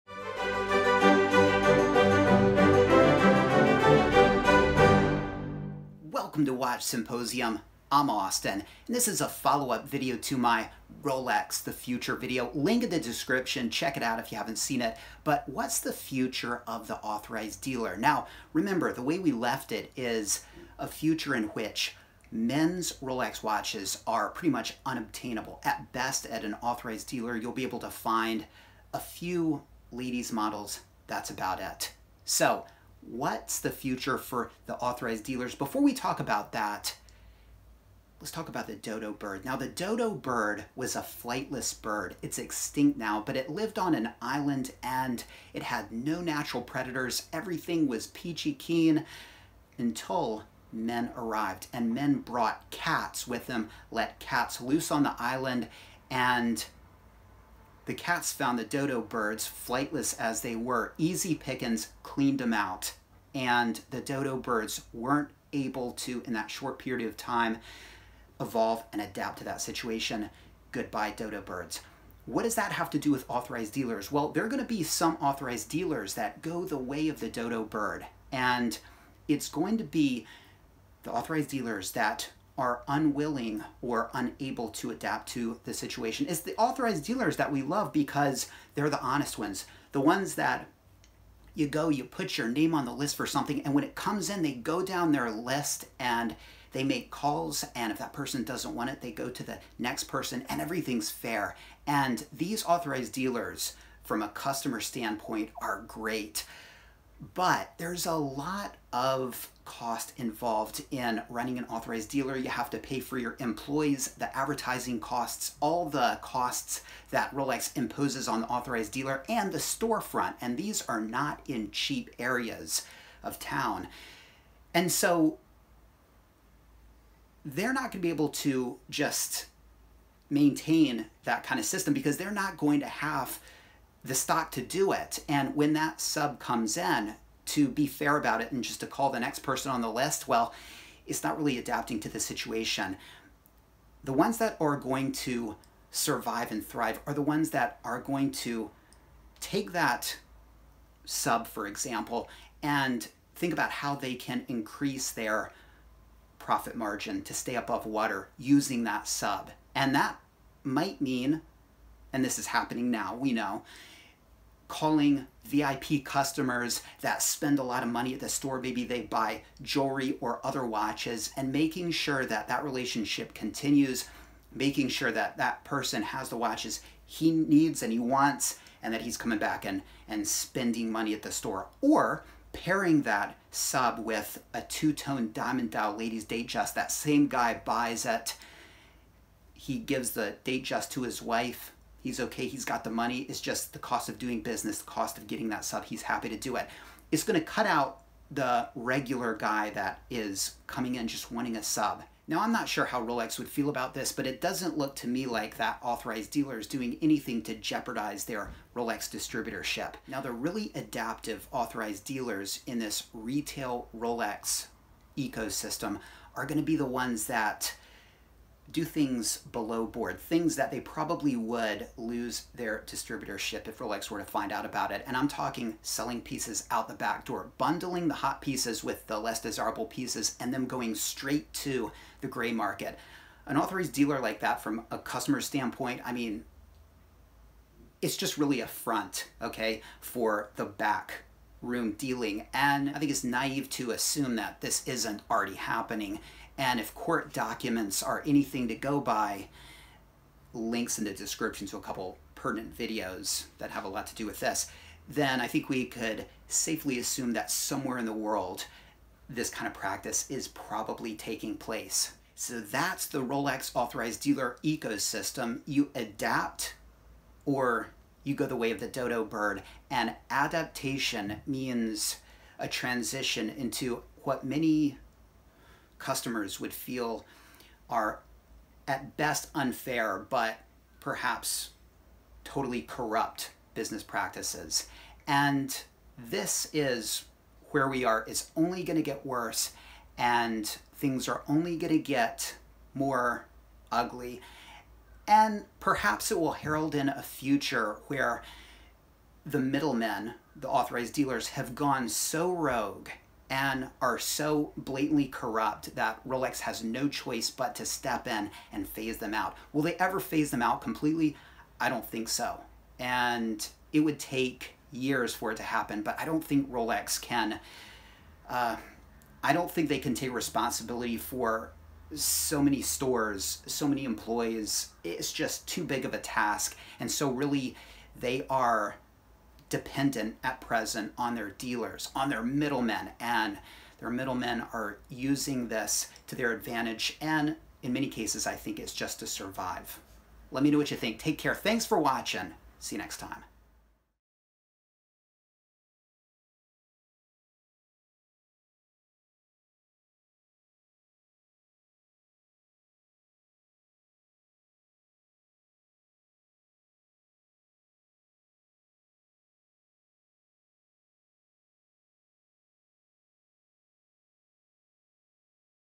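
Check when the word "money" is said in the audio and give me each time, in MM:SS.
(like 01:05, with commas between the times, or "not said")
02:47, 03:00, 03:12.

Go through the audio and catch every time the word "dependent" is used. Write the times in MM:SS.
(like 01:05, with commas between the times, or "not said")
05:29.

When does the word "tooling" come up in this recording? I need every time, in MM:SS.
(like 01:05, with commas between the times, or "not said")
not said.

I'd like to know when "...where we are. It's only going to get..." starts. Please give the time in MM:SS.
04:47.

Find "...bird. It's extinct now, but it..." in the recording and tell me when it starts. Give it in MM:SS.
00:41.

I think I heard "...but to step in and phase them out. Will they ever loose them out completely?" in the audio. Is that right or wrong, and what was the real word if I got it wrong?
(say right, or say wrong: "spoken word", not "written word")
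wrong: "phase", not "loose".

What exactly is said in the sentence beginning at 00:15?
But what's the future of the authorized dealer?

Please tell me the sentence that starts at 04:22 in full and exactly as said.
So that's the Rolex authorized dealer ecosystem.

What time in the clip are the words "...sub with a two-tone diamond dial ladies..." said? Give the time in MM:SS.
03:03.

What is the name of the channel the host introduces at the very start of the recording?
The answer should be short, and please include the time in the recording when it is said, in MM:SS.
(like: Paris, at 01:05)
Watch Symposium, at 00:06.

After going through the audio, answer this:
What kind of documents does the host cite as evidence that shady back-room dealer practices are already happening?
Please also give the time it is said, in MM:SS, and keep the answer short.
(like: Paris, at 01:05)
court documents, at 04:06.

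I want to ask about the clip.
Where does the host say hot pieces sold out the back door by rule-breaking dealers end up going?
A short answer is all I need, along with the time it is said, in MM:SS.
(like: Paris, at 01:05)
gray market, at 03:52.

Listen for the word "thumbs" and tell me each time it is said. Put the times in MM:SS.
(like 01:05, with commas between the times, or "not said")
not said.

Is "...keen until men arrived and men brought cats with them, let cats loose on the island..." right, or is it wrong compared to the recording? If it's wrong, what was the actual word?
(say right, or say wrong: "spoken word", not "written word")
right.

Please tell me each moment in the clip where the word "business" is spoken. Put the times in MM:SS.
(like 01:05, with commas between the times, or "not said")
03:14, 04:43.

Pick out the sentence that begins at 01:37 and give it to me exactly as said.
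And if that person doesn't want it, they go to the next person, and everything's fair.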